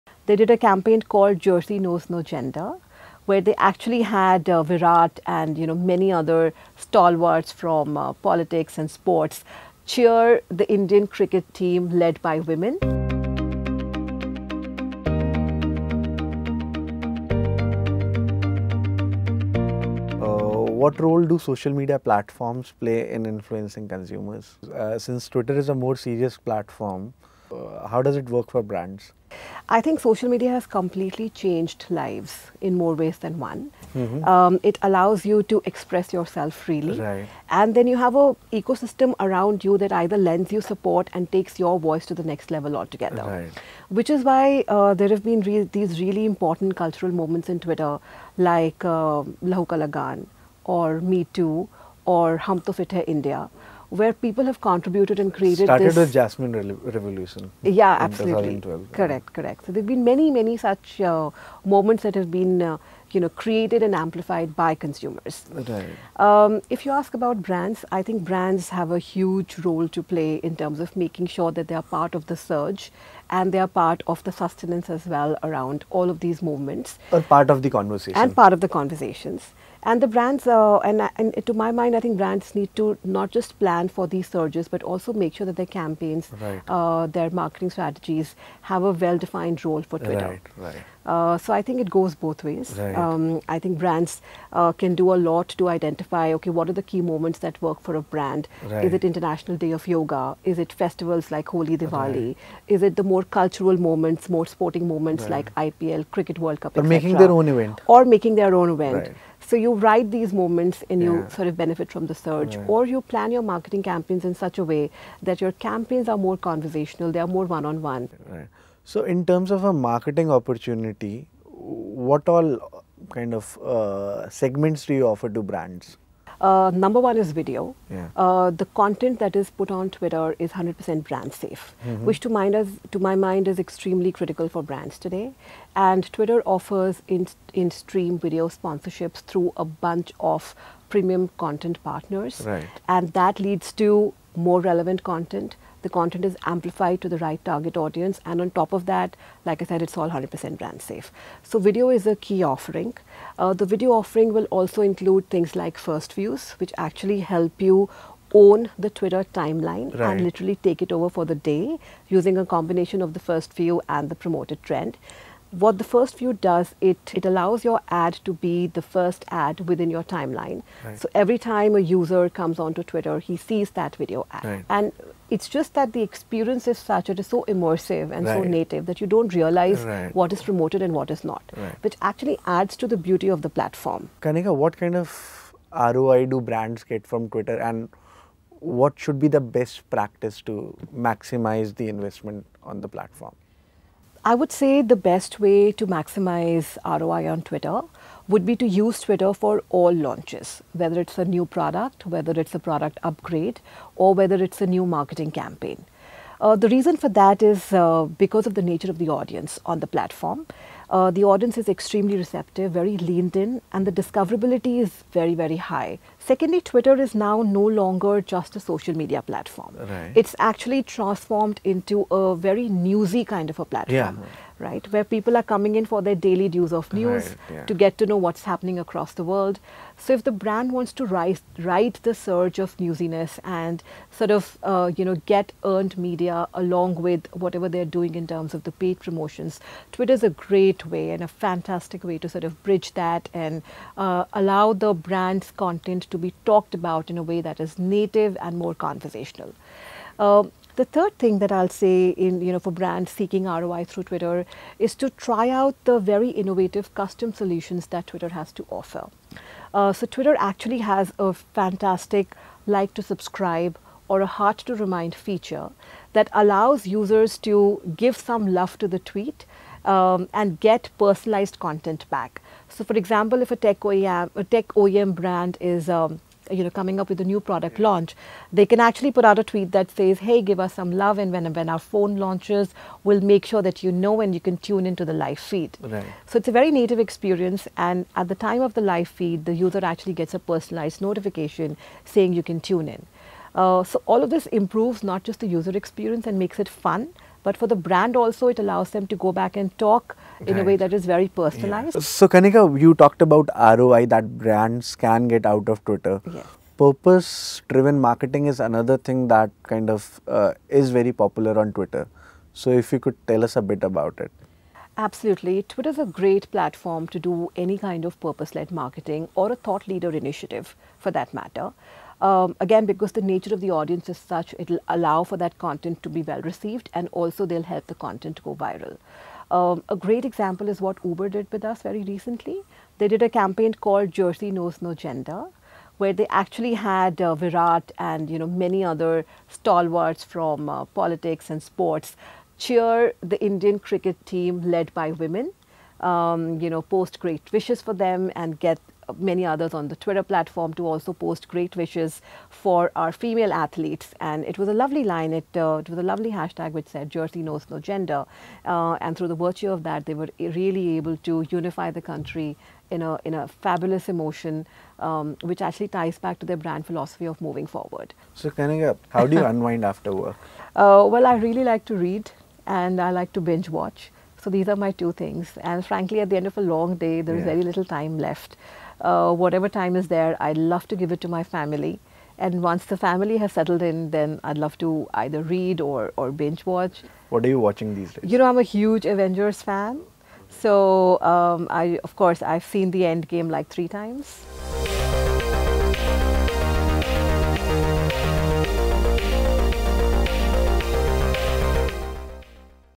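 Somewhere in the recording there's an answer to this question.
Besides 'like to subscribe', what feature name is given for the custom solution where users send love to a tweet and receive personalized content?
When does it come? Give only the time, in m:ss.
4:24.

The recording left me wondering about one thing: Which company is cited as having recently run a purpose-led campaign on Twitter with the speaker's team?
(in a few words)
Uber.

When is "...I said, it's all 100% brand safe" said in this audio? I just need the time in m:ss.
2:29.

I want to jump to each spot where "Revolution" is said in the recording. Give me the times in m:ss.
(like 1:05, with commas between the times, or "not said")
0:56.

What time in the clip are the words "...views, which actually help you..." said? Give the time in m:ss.
2:36.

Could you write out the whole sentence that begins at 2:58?
so native that you don't realize right.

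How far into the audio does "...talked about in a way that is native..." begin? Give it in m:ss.
4:06.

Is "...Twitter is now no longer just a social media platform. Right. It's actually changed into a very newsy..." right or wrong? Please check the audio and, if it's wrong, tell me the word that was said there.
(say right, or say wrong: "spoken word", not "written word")
wrong: "transformed", not "changed".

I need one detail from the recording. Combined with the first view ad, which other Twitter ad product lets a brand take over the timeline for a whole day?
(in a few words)
Promoted trend.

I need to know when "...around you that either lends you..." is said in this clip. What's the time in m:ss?
0:39.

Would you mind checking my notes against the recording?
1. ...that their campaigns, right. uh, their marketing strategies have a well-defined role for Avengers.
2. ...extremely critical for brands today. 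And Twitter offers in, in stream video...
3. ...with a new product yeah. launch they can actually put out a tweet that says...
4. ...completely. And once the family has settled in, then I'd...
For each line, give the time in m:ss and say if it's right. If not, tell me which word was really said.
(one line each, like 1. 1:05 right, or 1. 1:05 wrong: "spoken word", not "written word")
1. 1:25 wrong: "Twitter", not "Avengers"
2. 2:13 right
3. 4:37 right
4. 6:21 wrong: "family", not "completely".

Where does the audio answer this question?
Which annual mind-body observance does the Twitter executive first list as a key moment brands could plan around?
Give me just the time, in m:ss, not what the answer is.
1:39.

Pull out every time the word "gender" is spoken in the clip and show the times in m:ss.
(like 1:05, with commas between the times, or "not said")
0:02, 5:34, 5:57.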